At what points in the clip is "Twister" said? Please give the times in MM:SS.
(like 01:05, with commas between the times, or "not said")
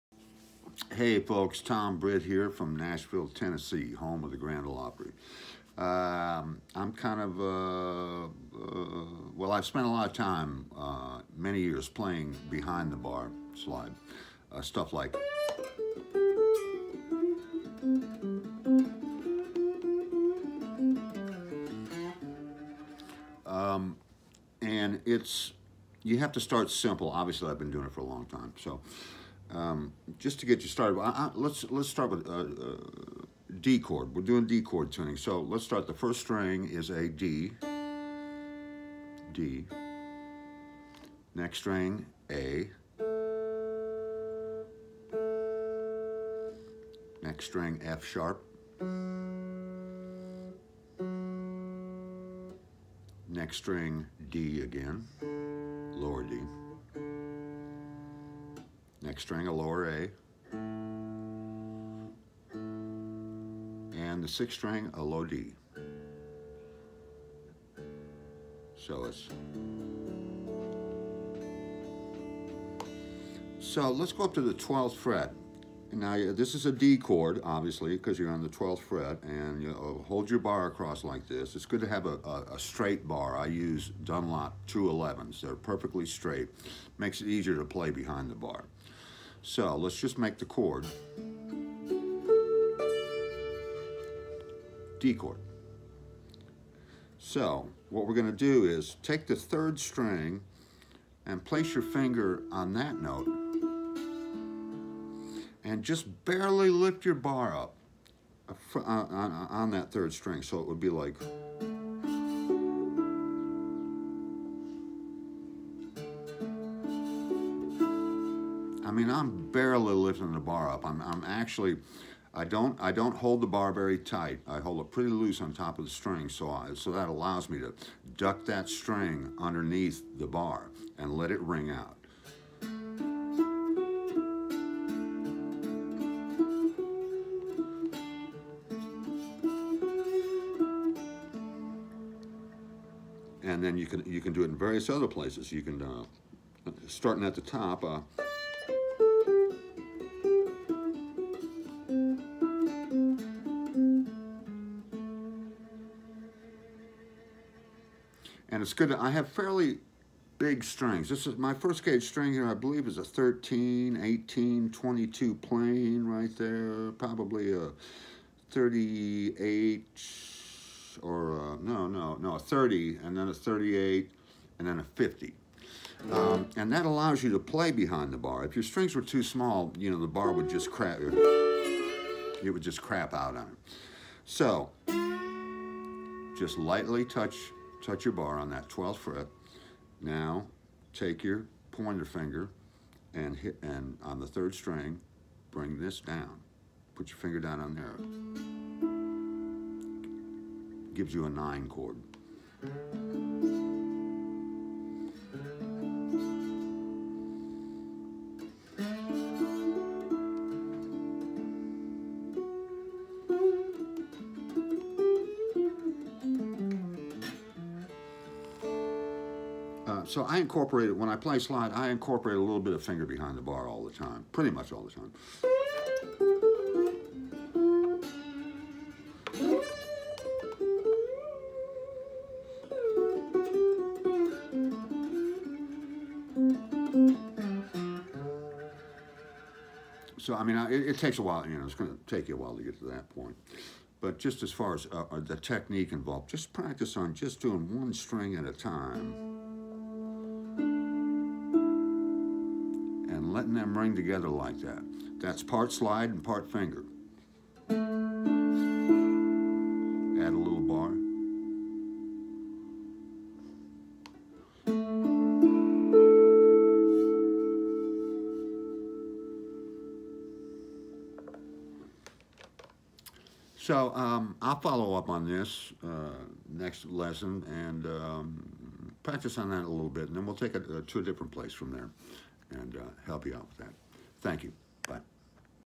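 not said.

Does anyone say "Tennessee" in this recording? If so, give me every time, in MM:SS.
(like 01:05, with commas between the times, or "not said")
00:03.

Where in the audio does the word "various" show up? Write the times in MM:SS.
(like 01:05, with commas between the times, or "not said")
02:24.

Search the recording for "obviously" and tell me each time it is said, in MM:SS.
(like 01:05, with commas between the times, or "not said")
00:27, 01:17.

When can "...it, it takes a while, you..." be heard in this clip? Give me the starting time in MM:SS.
04:00.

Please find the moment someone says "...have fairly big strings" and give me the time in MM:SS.
02:39.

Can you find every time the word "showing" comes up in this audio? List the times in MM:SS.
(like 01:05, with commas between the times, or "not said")
not said.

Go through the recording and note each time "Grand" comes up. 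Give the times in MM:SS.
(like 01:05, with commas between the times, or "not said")
00:04.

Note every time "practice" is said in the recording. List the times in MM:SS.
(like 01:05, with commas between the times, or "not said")
04:06, 04:39.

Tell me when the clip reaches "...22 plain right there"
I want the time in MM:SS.
02:44.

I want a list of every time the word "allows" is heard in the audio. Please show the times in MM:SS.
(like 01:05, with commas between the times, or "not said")
02:07, 02:56.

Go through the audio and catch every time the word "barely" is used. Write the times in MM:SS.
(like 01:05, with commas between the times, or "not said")
01:46, 01:59.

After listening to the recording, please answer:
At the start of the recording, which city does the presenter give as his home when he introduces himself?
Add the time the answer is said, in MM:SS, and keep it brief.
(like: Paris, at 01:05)
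Nashville, at 00:02.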